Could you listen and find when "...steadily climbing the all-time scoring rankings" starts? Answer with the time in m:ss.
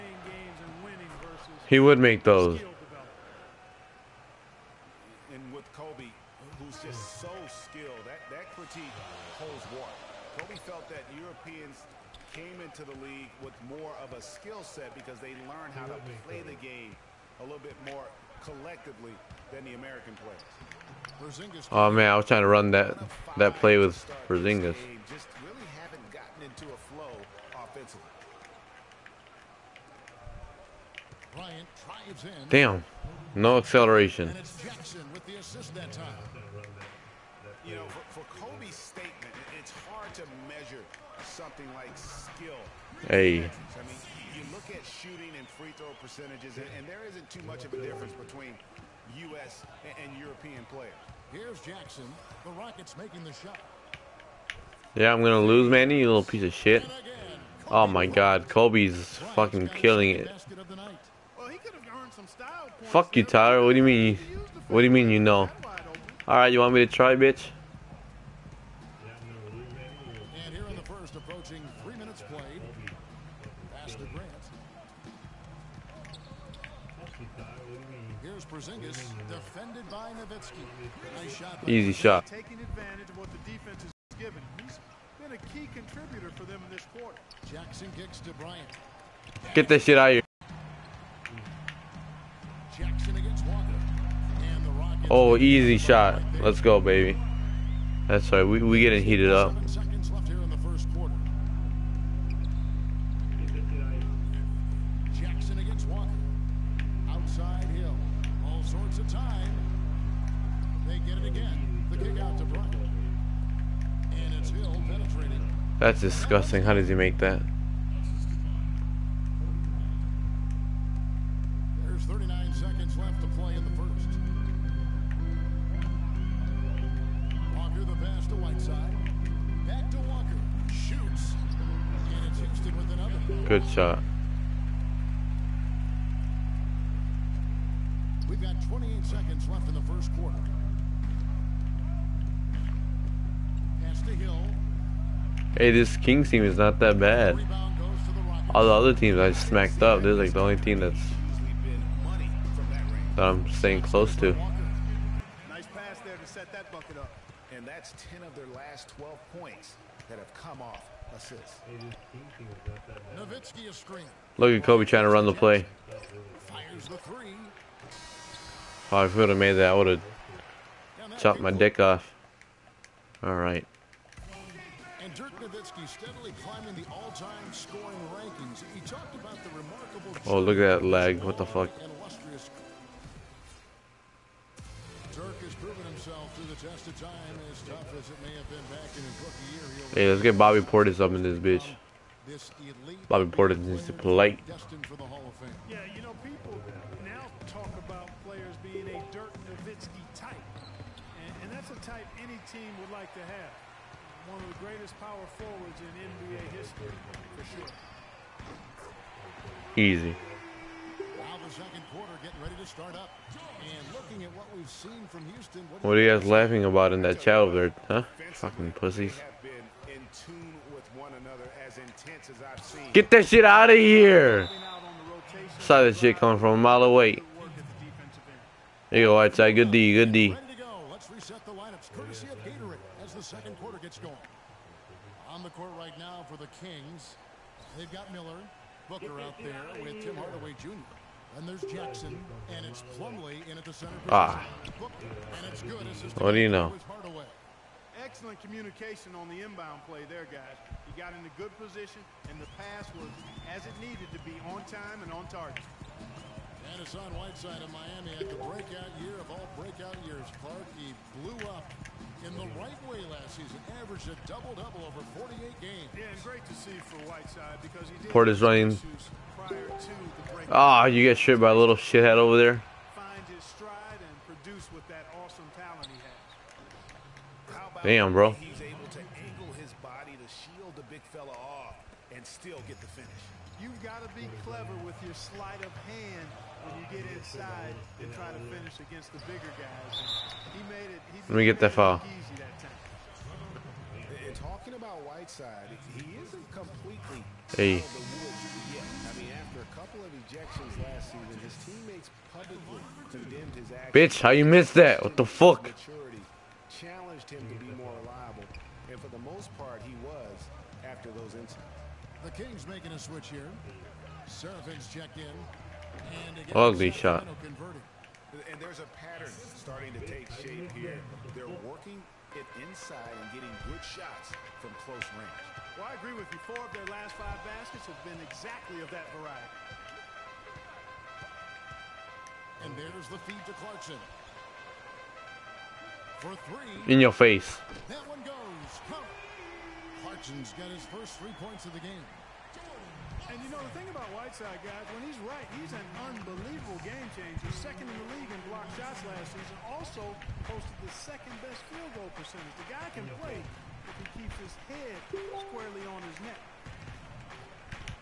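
2:55.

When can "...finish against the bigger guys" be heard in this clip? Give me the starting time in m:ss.
4:48.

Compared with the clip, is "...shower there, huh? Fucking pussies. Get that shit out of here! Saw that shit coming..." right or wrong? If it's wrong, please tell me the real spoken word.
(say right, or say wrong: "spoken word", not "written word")
right.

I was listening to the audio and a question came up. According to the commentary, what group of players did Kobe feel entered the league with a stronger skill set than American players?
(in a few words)
Europeans.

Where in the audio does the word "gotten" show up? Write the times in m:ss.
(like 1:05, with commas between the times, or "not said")
0:26.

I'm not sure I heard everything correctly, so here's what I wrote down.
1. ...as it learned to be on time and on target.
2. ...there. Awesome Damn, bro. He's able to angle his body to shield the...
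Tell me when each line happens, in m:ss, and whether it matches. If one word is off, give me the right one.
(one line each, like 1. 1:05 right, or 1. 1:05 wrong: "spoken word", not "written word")
1. 4:13 wrong: "needed", not "learned"
2. 4:32 right.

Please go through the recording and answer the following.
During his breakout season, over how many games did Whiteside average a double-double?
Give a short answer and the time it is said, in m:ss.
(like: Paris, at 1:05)
48, at 4:25.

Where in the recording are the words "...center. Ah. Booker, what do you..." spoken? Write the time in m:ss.
4:03.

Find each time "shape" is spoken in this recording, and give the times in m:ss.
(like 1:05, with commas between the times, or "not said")
5:20.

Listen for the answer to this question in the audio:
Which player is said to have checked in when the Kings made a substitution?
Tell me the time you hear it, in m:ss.
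5:14.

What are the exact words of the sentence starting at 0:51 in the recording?
Here's Jackson, the Rockets making the shot.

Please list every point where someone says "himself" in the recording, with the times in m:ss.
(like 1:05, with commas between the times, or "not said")
3:05.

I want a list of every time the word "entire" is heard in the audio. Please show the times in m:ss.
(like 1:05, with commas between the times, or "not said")
not said.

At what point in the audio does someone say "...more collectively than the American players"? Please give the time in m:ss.
0:17.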